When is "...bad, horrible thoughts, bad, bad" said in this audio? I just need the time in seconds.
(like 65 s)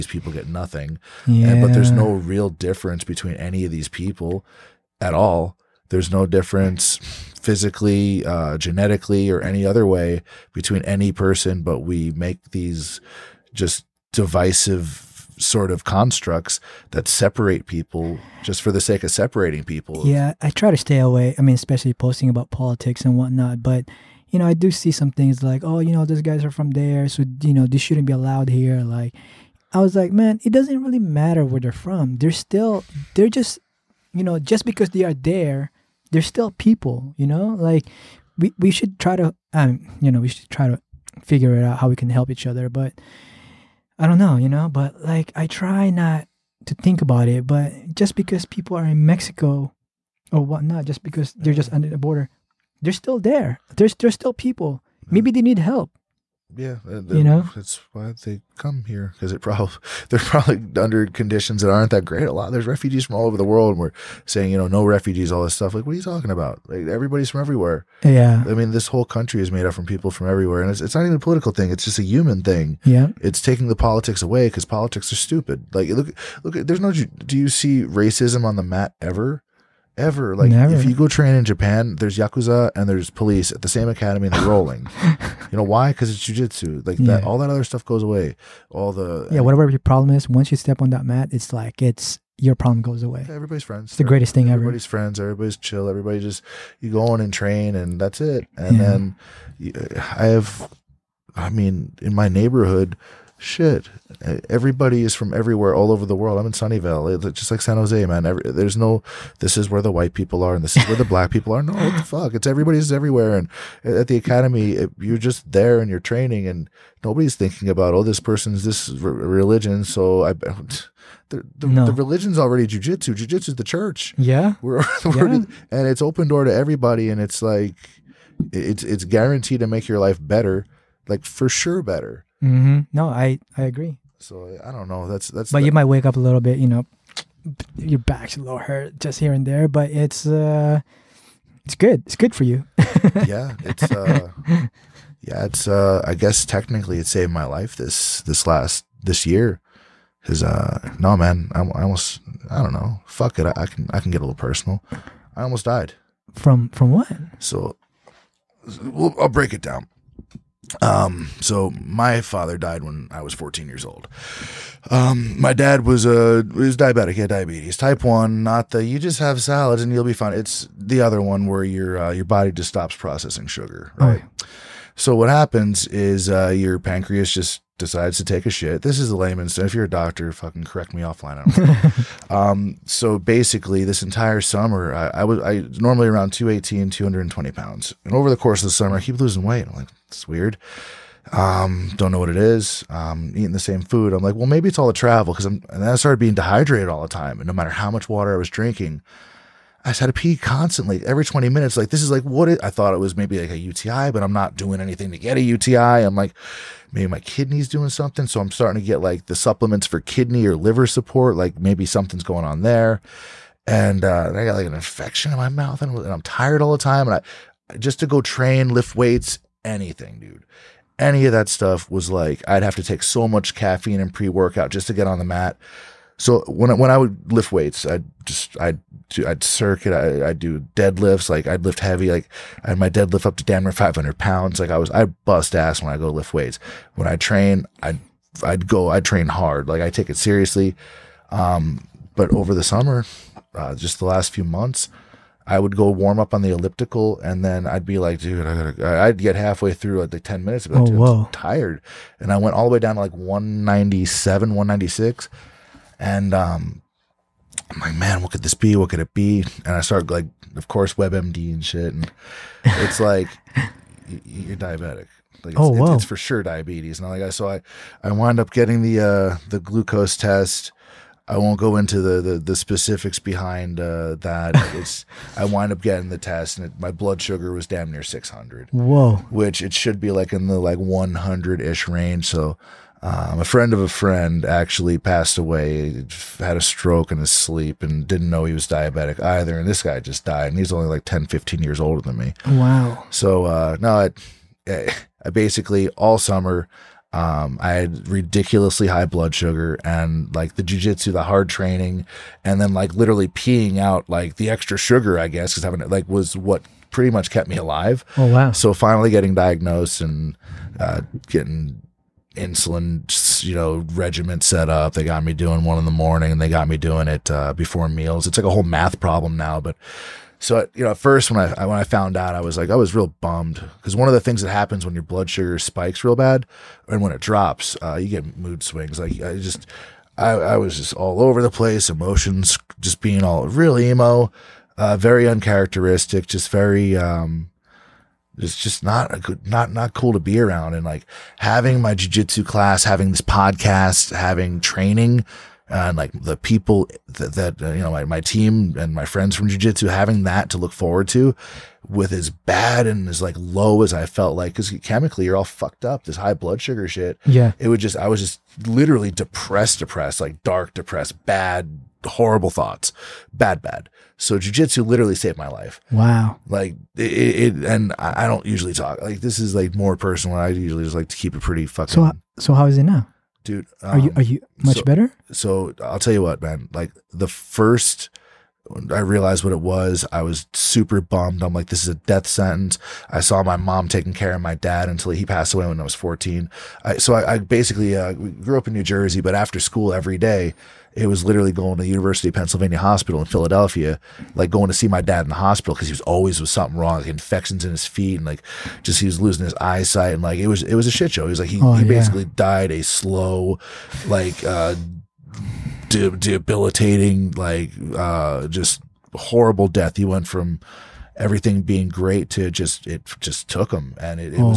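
361 s.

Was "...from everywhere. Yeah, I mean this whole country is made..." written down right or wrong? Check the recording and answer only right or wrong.
right.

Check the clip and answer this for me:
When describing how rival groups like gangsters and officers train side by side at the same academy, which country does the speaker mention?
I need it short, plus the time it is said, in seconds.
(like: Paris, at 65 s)
Japan, at 81 s.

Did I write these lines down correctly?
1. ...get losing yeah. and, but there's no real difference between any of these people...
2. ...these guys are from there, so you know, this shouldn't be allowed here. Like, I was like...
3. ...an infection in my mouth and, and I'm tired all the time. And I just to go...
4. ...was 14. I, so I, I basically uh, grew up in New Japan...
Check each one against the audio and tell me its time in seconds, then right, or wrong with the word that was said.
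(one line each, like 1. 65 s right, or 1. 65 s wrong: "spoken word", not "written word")
1. 0 s wrong: "nothing", not "losing"
2. 26 s right
3. 214 s right
4. 385 s wrong: "Jersey", not "Japan".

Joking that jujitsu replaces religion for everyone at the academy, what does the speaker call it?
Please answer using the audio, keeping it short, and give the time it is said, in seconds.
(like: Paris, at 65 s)
the church, at 123 s.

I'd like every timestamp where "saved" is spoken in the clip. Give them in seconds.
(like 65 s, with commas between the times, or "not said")
147 s, 365 s.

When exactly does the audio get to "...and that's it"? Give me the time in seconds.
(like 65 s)
97 s.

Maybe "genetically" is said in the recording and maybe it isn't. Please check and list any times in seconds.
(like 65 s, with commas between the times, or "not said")
8 s.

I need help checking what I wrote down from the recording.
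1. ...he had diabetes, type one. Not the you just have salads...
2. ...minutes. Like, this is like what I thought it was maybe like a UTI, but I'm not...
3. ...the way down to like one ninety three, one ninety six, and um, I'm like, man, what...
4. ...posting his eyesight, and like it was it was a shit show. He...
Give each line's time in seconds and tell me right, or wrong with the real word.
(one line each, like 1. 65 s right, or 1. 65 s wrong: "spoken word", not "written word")
1. 167 s right
2. 201 s right
3. 252 s wrong: "seven", not "three"
4. 399 s wrong: "losing", not "posting".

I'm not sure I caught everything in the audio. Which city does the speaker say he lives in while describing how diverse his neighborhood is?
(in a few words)
Sunnyvale.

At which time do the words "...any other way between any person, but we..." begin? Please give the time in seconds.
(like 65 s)
9 s.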